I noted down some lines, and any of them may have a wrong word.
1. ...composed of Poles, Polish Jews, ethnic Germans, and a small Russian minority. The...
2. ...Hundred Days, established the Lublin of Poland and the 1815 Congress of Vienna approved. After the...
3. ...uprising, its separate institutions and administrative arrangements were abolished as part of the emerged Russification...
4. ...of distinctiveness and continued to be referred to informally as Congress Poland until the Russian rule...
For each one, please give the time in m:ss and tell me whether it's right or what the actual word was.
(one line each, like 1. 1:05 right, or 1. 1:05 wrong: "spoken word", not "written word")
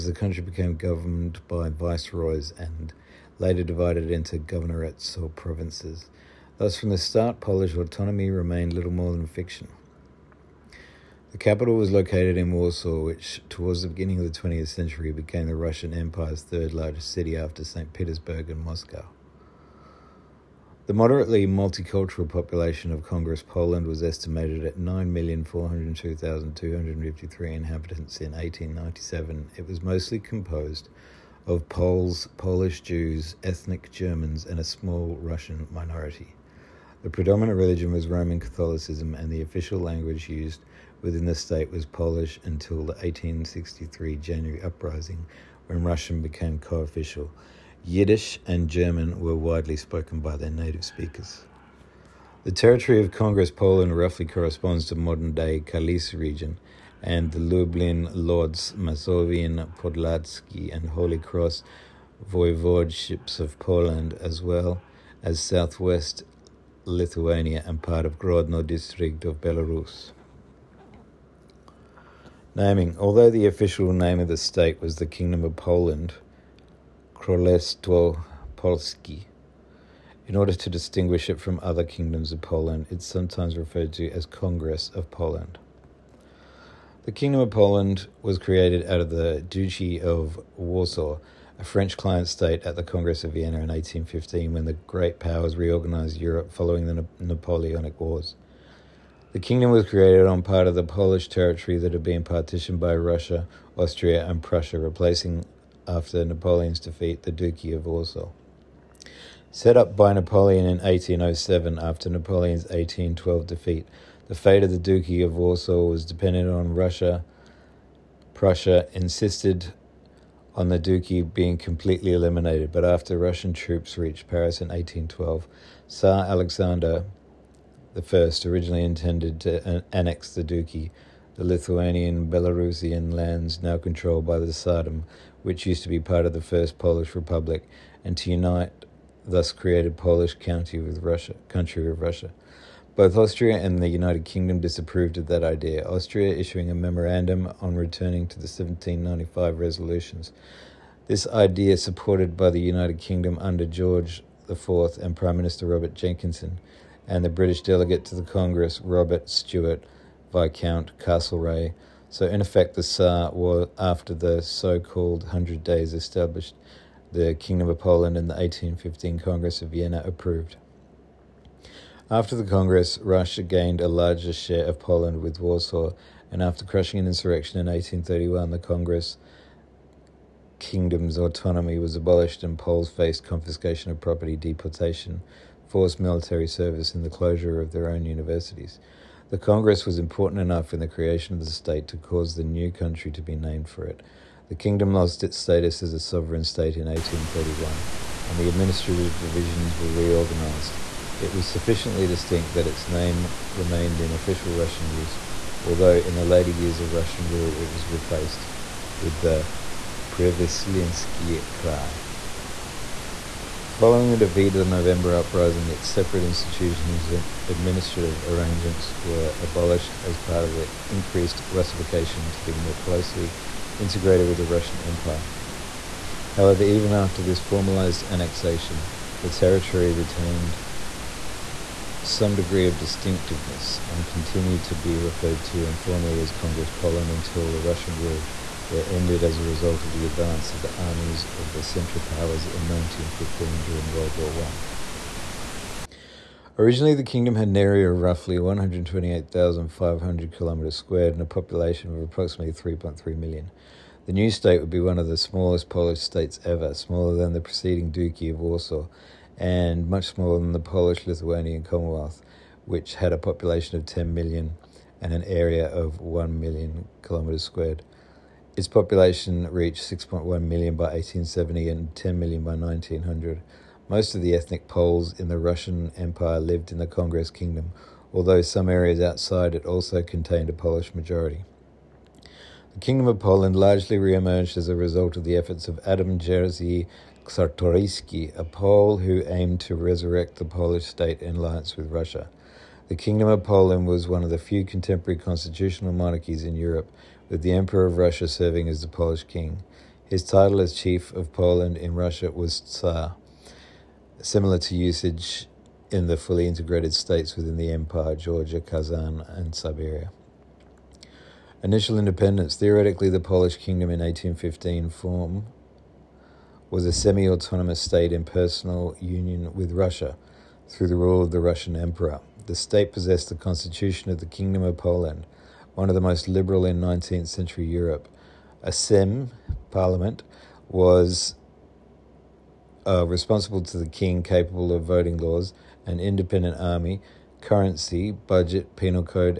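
1. 0:30 right
2. 2:45 wrong: "Kingdom", not "Lublin"
3. 3:35 wrong: "increased", not "emerged"
4. 3:52 right.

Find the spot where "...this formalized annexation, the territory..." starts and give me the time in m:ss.
3:47.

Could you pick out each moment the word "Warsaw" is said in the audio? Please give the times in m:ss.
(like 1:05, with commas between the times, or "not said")
0:12, 1:30, 1:47, 1:55, 2:55, 4:18.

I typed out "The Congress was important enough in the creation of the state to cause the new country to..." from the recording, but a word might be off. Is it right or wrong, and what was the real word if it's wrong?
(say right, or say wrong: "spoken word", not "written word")
right.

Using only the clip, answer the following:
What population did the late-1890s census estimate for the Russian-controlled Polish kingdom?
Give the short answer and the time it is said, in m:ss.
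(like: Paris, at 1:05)
9,402,253, at 0:24.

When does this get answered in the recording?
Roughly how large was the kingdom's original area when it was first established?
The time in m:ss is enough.
4:08.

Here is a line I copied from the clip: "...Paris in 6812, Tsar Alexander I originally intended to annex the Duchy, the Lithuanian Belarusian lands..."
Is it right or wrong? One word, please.
wrong.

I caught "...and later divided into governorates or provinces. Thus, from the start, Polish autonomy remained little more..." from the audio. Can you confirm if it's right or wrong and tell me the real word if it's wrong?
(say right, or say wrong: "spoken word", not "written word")
right.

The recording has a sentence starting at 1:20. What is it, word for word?
In order to distinguish it from other kingdoms of Poland, it's sometimes referred to as Congress of Poland.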